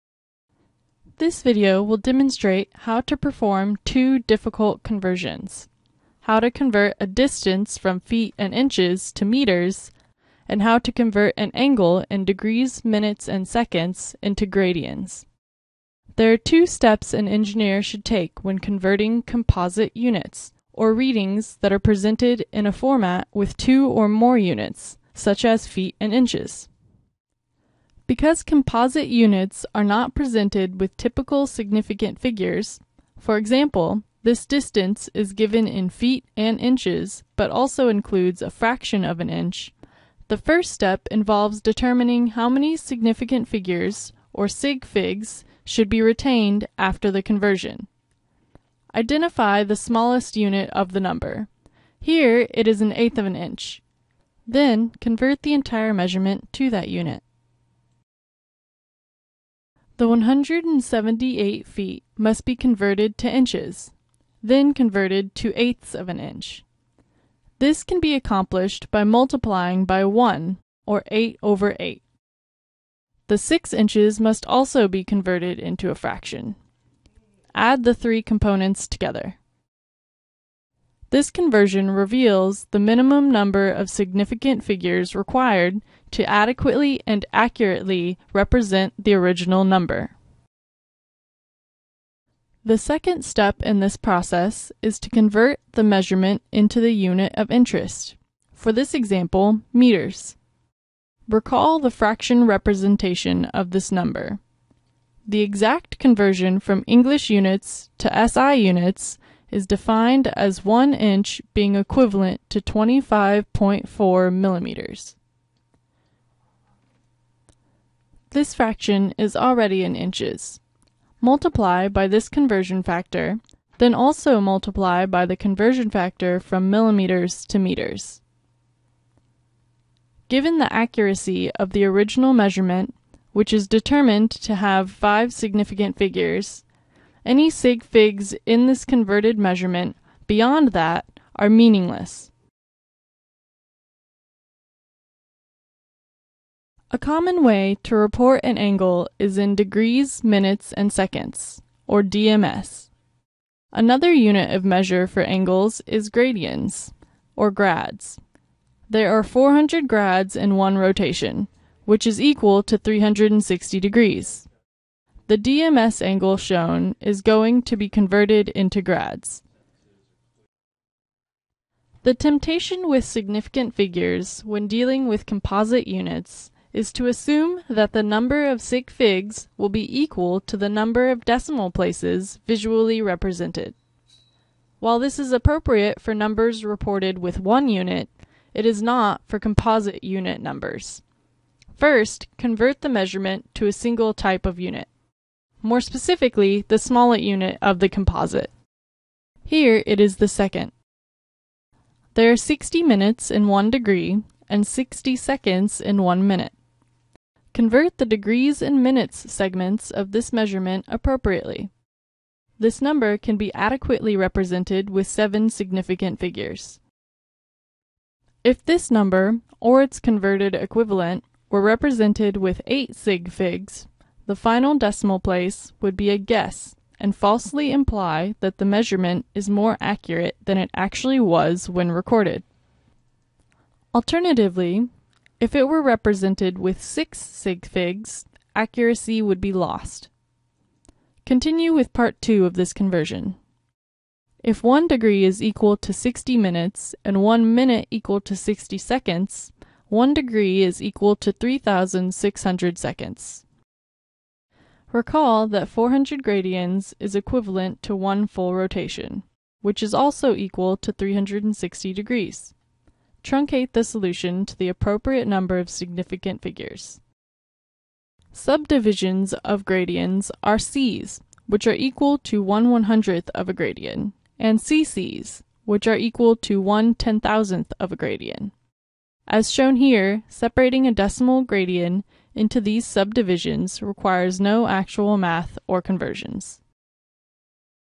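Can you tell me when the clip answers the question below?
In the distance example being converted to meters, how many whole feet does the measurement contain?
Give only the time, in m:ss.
1:00.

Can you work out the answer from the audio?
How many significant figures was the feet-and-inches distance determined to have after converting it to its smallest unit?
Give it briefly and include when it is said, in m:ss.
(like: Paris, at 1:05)
5, at 2:14.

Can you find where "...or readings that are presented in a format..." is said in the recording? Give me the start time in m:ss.
0:20.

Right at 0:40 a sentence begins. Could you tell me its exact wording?
The first step involves determining how many significant figures, or sig figs, should be retained after the conversion.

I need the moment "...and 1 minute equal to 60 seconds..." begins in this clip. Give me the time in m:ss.
4:07.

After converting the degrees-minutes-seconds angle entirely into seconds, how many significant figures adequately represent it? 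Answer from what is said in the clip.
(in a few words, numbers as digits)
7.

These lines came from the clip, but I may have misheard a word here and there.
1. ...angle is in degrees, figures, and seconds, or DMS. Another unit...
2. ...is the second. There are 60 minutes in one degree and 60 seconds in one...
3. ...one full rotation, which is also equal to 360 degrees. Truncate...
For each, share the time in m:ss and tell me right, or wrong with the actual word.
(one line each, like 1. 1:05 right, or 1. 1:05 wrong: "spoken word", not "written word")
1. 2:28 wrong: "minutes", not "figures"
2. 3:19 right
3. 4:17 right.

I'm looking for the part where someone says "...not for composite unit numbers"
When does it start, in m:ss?
3:08.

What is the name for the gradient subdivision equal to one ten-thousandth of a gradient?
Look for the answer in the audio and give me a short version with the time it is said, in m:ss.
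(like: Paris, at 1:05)
Ccs, at 4:34.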